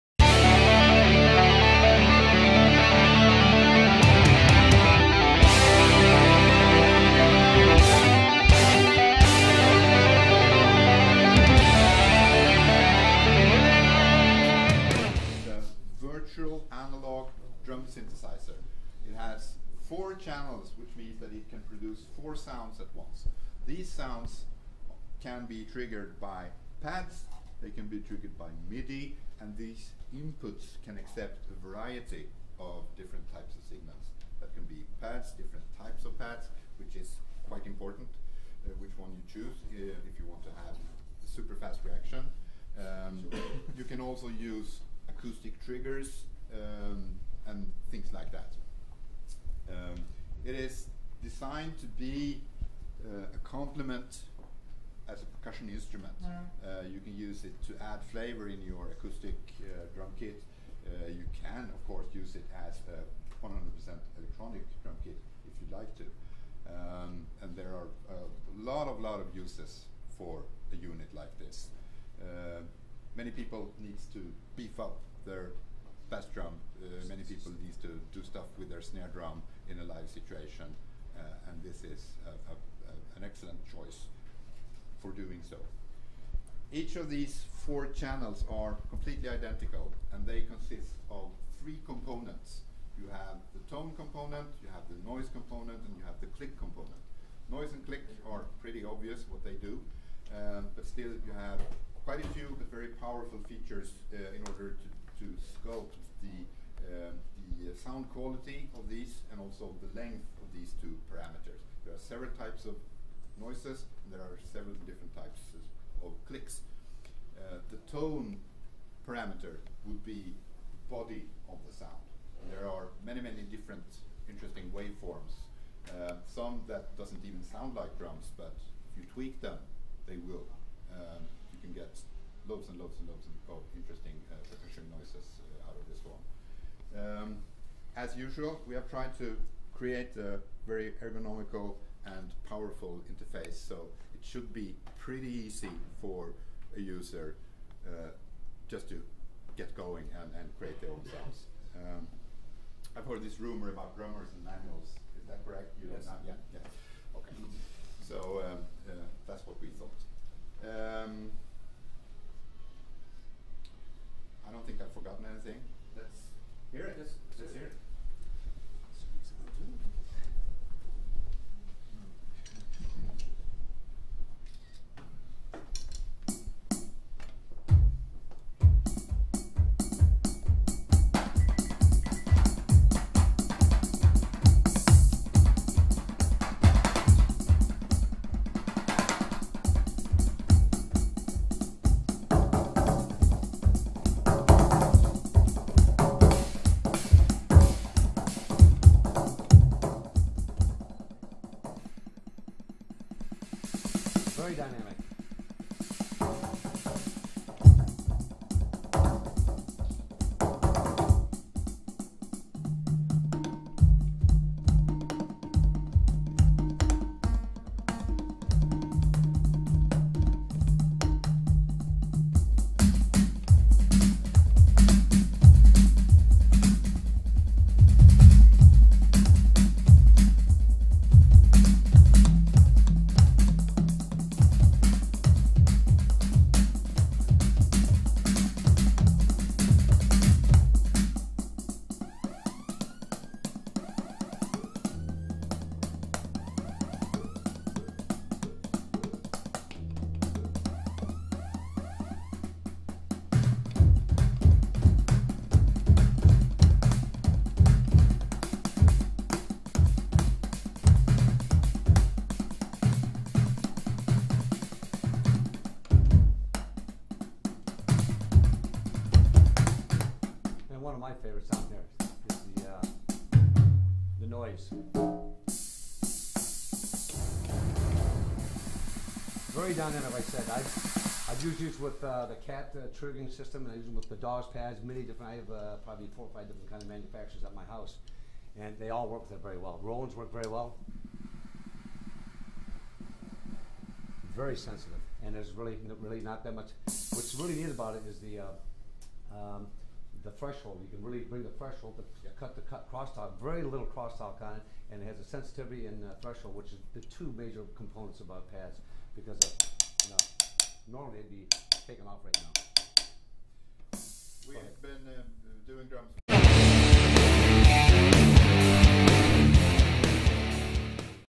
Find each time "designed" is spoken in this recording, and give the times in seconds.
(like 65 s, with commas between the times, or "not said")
51 s.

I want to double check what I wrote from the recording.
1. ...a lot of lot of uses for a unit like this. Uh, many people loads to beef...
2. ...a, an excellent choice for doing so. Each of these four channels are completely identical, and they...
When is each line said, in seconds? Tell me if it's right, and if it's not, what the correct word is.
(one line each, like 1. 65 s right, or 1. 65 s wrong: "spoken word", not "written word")
1. 68 s wrong: "needs", not "loads"
2. 82 s right.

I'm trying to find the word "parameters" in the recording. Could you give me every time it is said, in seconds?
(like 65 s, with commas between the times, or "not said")
111 s, 119 s.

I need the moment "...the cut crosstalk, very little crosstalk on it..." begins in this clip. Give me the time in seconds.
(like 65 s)
302 s.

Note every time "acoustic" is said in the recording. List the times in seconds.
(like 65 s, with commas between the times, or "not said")
45 s, 58 s.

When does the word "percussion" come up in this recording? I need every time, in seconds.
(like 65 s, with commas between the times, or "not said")
55 s, 134 s.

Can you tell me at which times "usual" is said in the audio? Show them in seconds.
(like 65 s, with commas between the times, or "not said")
138 s.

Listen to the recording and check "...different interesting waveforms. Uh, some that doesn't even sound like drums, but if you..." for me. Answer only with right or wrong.
right.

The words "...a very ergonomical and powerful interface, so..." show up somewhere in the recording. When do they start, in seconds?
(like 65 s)
140 s.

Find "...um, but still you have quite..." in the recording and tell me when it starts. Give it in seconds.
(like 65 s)
100 s.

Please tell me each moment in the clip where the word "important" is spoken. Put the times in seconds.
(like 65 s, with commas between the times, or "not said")
37 s.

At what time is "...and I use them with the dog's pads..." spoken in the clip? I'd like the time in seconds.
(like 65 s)
283 s.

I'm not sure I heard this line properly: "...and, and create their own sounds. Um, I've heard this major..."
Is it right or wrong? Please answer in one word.
wrong.